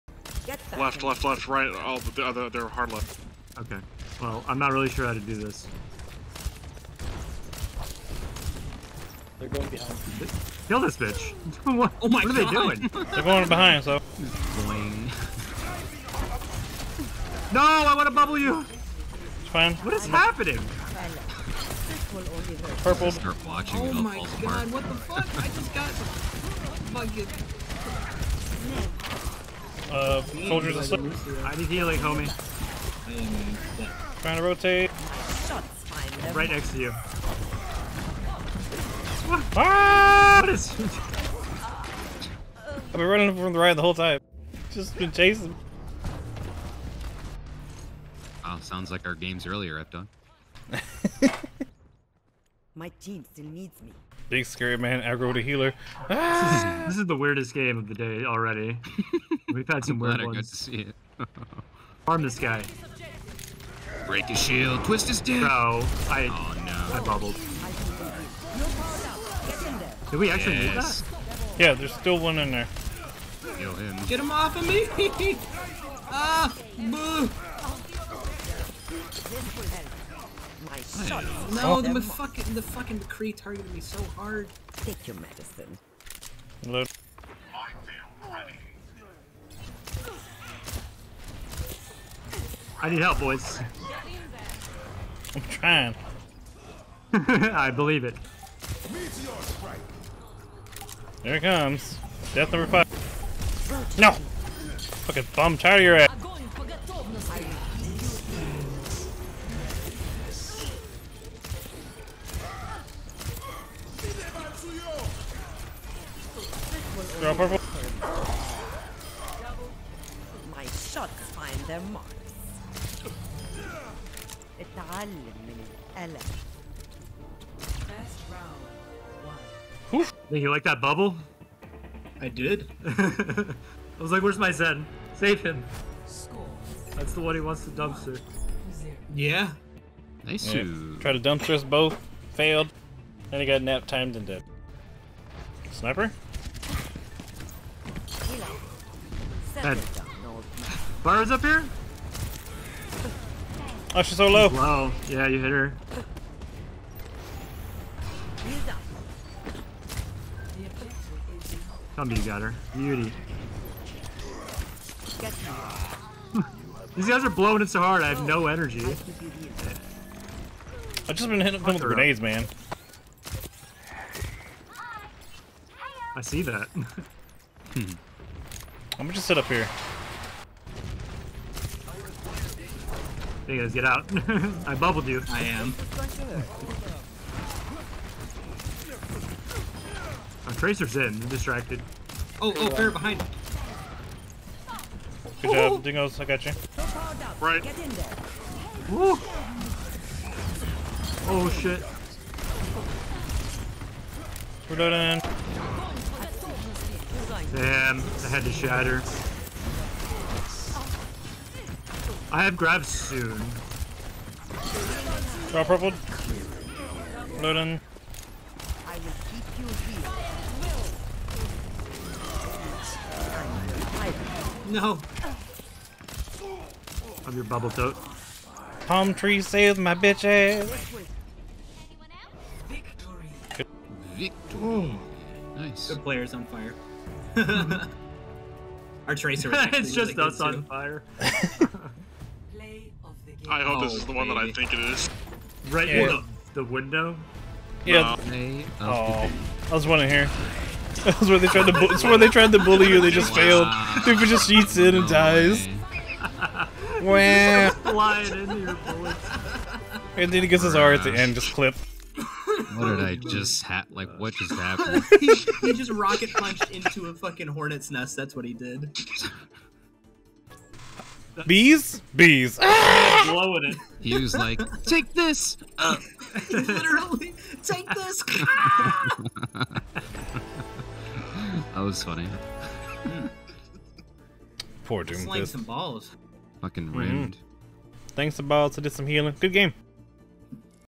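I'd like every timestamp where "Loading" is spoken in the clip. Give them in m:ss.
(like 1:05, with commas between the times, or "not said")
3:37.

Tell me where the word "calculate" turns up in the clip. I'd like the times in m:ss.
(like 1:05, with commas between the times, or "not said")
not said.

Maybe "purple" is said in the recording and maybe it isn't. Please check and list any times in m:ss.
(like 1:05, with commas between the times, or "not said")
0:22, 1:57, 3:35.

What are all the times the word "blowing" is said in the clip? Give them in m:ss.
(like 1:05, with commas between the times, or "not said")
2:47, 4:33.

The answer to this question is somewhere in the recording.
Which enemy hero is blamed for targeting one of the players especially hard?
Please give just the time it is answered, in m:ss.
1:22.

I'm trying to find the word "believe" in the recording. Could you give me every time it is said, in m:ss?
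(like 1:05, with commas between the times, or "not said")
1:37.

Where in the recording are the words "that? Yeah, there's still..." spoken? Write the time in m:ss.
1:11.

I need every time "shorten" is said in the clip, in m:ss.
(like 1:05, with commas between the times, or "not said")
not said.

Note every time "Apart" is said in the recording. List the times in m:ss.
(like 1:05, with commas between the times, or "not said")
0:24.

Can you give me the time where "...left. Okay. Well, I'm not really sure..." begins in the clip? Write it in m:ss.
0:02.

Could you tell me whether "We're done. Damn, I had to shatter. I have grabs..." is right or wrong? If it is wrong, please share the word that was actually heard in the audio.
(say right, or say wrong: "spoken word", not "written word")
right.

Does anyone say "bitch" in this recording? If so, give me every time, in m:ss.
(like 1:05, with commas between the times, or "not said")
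0:10, 3:49.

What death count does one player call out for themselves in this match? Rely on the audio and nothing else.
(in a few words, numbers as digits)
5.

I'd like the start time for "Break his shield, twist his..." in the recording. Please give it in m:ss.
1:04.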